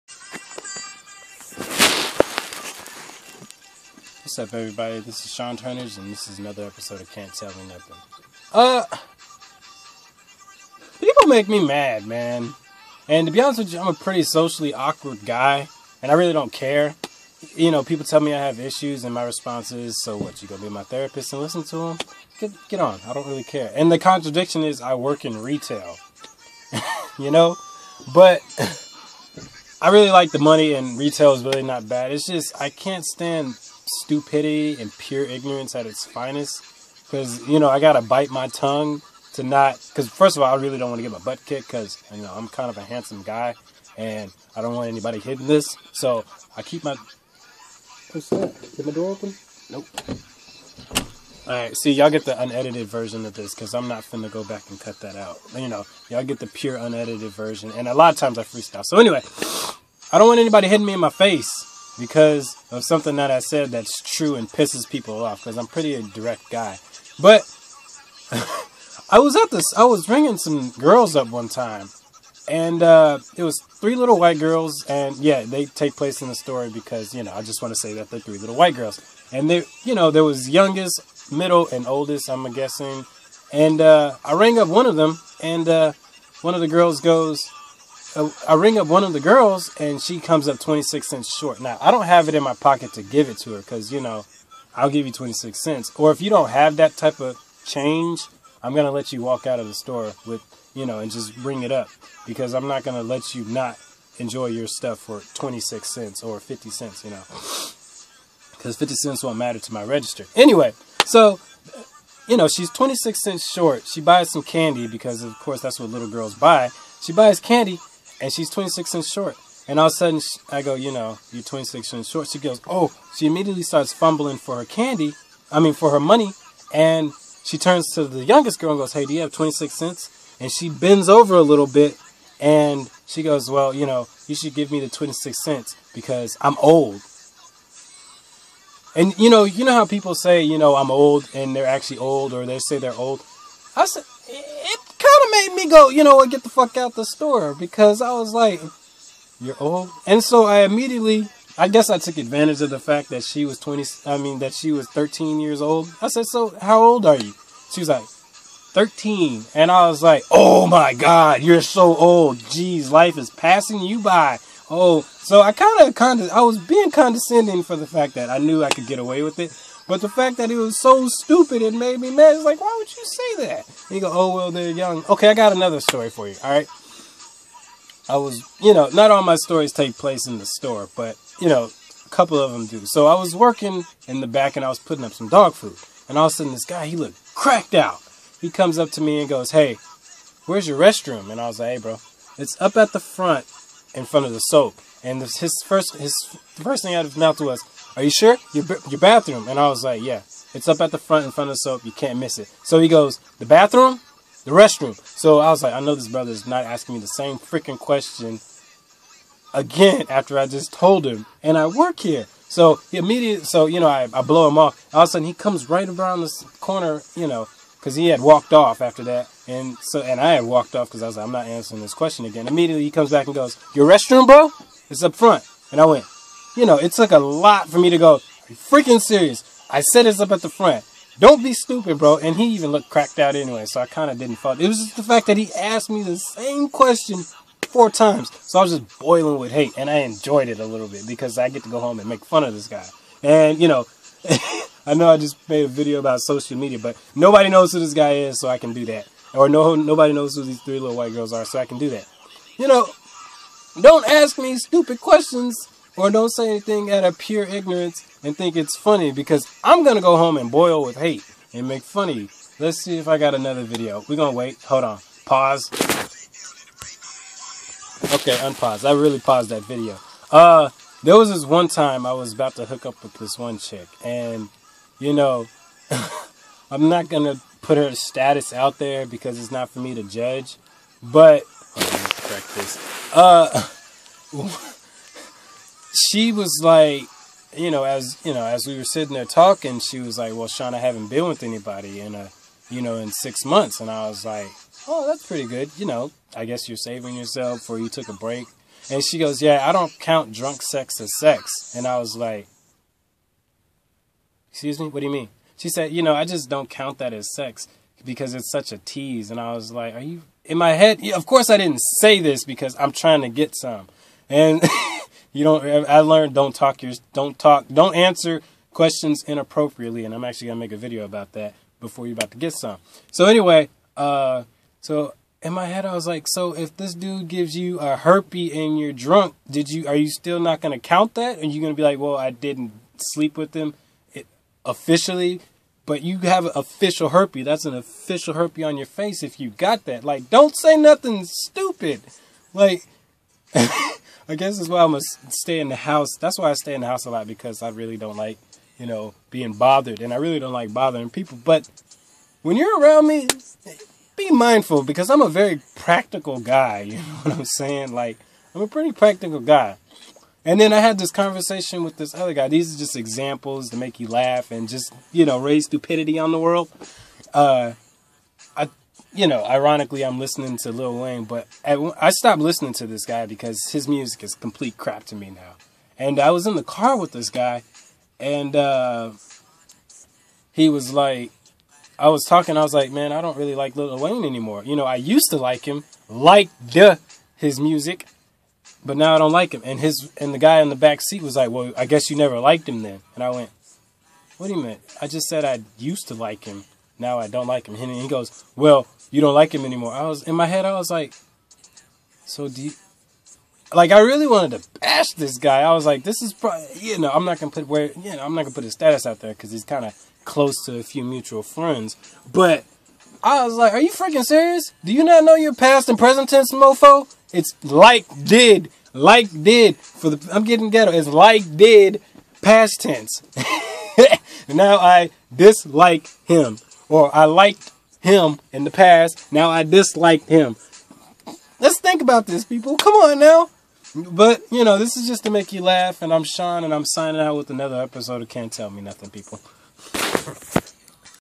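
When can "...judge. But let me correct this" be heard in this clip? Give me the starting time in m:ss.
4:40.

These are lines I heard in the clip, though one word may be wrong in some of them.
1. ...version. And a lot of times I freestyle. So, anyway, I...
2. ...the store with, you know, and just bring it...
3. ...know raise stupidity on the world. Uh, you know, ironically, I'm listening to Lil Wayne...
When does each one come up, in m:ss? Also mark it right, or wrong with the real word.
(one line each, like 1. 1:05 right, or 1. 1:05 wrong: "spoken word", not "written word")
1. 0:57 right
2. 1:39 right
3. 6:05 right.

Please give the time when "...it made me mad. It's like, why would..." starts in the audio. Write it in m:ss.
2:51.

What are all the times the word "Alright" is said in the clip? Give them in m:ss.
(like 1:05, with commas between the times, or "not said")
0:51.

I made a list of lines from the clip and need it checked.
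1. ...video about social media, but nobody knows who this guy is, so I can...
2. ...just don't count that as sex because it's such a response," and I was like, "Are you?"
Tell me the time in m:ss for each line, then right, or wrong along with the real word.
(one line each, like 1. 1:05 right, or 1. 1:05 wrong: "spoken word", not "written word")
1. 4:05 right
2. 5:06 wrong: "tease", not "response".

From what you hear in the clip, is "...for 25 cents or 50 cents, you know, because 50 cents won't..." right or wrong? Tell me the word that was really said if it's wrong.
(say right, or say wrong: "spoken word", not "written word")
wrong: "26", not "25".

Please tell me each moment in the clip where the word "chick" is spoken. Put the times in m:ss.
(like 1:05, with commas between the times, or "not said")
4:33.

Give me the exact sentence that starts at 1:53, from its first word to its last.
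She buys some candy because, of course, that's what little girls buy.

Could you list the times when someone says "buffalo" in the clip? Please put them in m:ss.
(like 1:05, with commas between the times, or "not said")
not said.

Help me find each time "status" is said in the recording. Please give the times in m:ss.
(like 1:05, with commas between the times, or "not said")
4:37, 6:48.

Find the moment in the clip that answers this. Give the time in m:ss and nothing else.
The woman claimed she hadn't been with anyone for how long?
4:53.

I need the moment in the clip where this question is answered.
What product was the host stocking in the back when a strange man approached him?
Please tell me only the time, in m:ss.
3:05.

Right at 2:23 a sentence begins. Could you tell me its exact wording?
I said, kind of made me go, you know what, get the fuck out the store because I was like, you're old.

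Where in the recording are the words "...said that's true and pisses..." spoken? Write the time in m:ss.
1:03.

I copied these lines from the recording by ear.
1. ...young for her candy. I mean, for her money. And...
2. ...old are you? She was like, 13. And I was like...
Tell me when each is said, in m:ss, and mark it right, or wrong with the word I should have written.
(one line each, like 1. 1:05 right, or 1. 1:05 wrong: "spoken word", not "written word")
1. 2:03 wrong: "fumbling", not "young"
2. 2:36 right.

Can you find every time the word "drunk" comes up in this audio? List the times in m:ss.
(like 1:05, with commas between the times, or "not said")
5:00, 5:28.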